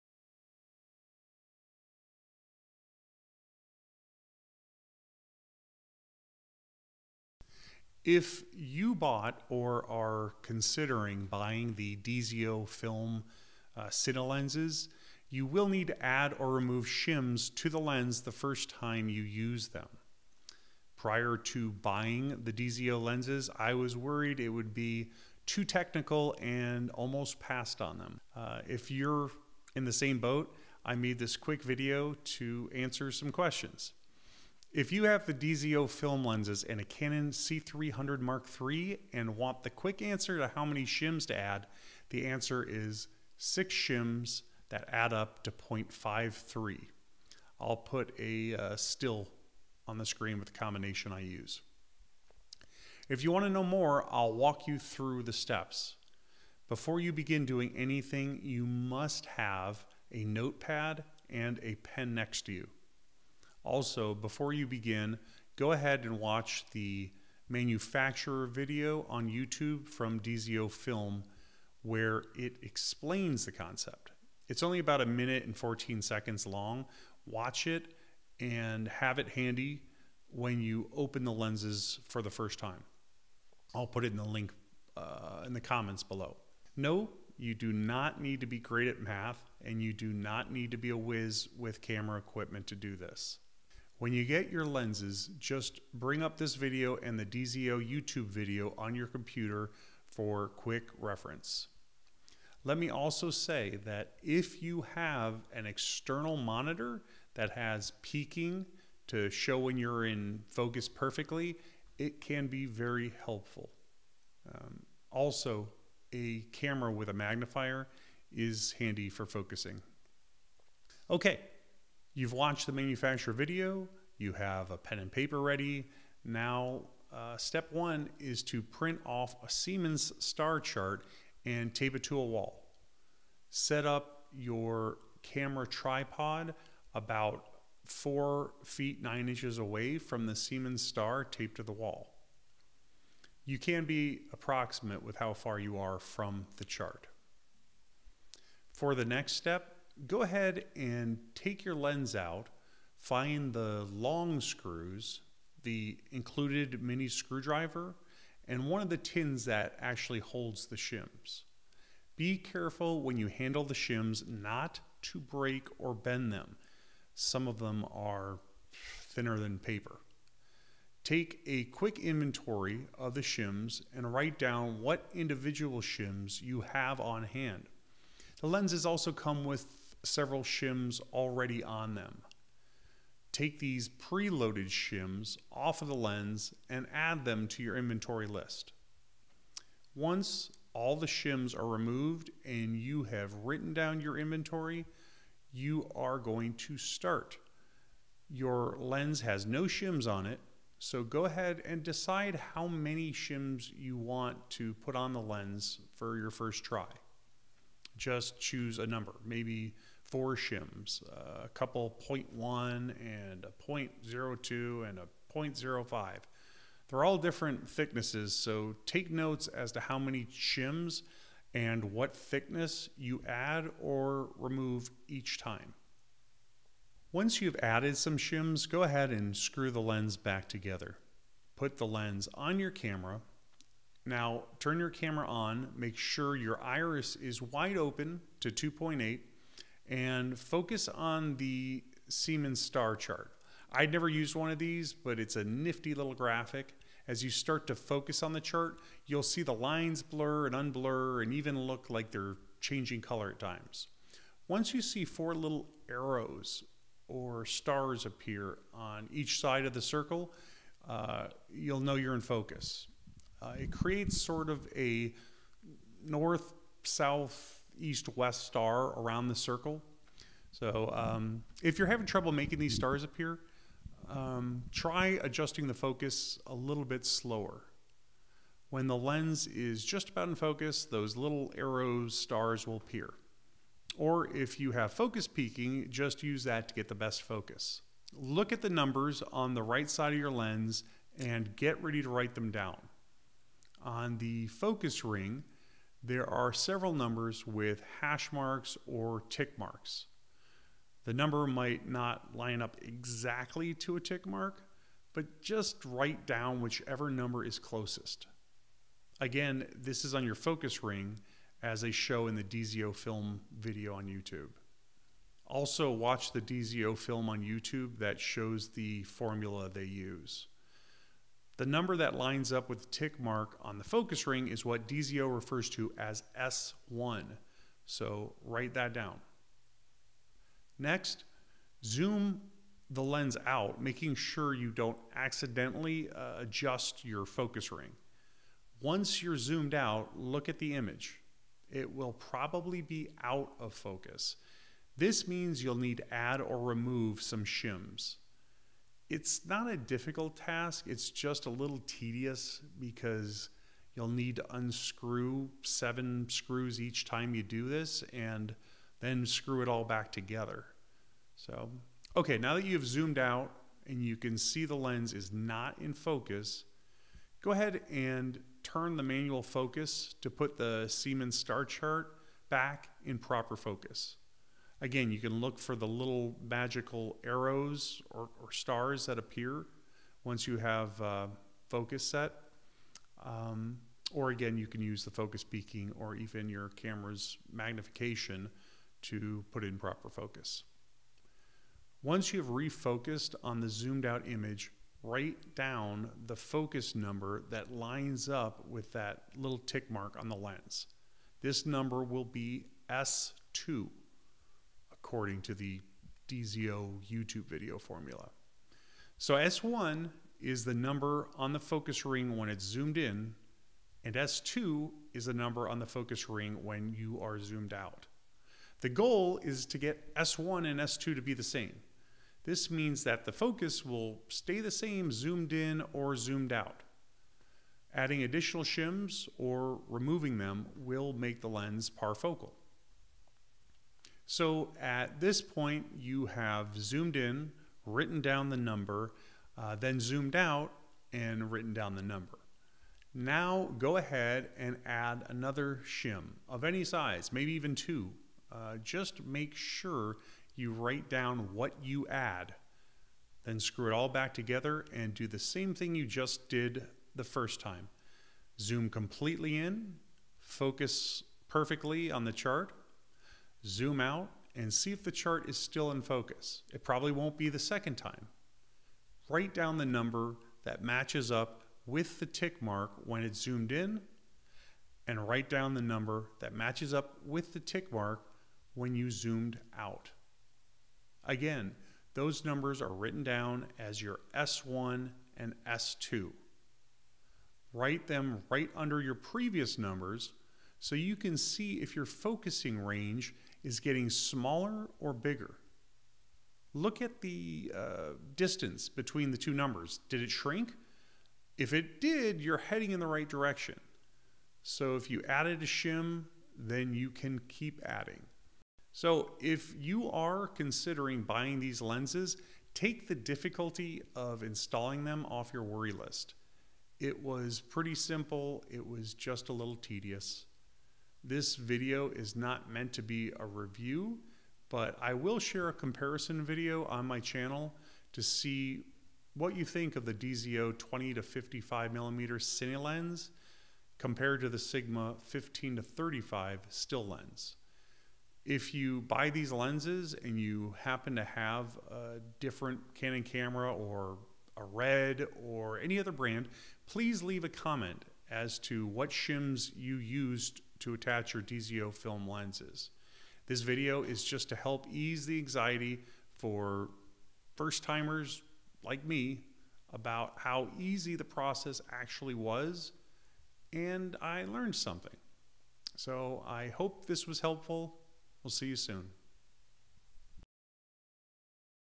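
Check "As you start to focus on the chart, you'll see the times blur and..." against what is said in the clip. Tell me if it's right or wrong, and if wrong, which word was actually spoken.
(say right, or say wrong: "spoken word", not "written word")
wrong: "lines", not "times".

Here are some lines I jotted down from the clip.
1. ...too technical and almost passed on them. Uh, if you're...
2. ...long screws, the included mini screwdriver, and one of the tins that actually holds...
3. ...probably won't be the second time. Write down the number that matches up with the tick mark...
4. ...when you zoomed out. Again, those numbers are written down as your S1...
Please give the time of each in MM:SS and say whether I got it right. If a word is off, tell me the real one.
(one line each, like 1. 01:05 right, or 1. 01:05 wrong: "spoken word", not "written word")
1. 00:25 right
2. 02:33 right
3. 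07:46 right
4. 07:58 right.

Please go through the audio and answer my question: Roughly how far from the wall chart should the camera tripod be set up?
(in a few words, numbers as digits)
4 feet 9 inches.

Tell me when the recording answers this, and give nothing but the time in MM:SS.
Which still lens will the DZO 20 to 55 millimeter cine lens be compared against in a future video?
08:54.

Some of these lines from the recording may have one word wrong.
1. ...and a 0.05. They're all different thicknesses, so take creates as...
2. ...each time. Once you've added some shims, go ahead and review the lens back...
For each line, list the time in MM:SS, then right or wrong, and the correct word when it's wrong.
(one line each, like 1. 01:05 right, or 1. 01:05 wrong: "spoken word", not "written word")
1. 03:34 wrong: "notes", not "creates"
2. 03:45 wrong: "screw", not "review".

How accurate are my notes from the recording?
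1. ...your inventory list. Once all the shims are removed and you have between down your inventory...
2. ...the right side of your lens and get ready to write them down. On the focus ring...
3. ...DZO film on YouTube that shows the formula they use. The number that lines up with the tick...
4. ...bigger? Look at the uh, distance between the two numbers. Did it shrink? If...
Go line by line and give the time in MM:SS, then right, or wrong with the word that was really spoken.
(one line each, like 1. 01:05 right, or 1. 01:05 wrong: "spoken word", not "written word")
1. 03:07 wrong: "written", not "between"
2. 04:49 right
3. 05:16 right
4. 08:15 right.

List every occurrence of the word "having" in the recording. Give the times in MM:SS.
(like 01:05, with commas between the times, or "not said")
04:31.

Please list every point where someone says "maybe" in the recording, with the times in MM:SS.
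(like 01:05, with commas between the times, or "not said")
03:29, 07:27.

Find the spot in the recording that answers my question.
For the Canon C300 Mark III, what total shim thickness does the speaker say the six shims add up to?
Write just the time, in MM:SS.
00:45.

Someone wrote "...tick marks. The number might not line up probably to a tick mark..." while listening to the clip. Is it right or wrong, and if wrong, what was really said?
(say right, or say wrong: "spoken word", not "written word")
wrong: "exactly", not "probably".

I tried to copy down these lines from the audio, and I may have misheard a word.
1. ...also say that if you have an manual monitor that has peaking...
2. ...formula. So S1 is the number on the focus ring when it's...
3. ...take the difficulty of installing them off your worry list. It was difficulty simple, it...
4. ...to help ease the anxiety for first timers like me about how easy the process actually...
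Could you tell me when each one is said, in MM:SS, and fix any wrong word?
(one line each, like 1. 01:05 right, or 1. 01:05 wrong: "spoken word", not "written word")
1. 01:42 wrong: "external", not "manual"
2. 06:47 right
3. 08:32 wrong: "pretty", not "difficulty"
4. 09:14 right.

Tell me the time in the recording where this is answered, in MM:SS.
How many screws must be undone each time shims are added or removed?
05:55.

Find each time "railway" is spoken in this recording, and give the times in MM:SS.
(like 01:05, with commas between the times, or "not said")
not said.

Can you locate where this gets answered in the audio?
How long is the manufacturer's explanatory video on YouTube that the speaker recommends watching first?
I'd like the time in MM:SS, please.
01:15.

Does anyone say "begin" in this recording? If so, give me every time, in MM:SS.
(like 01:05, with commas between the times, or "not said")
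00:57, 01:04.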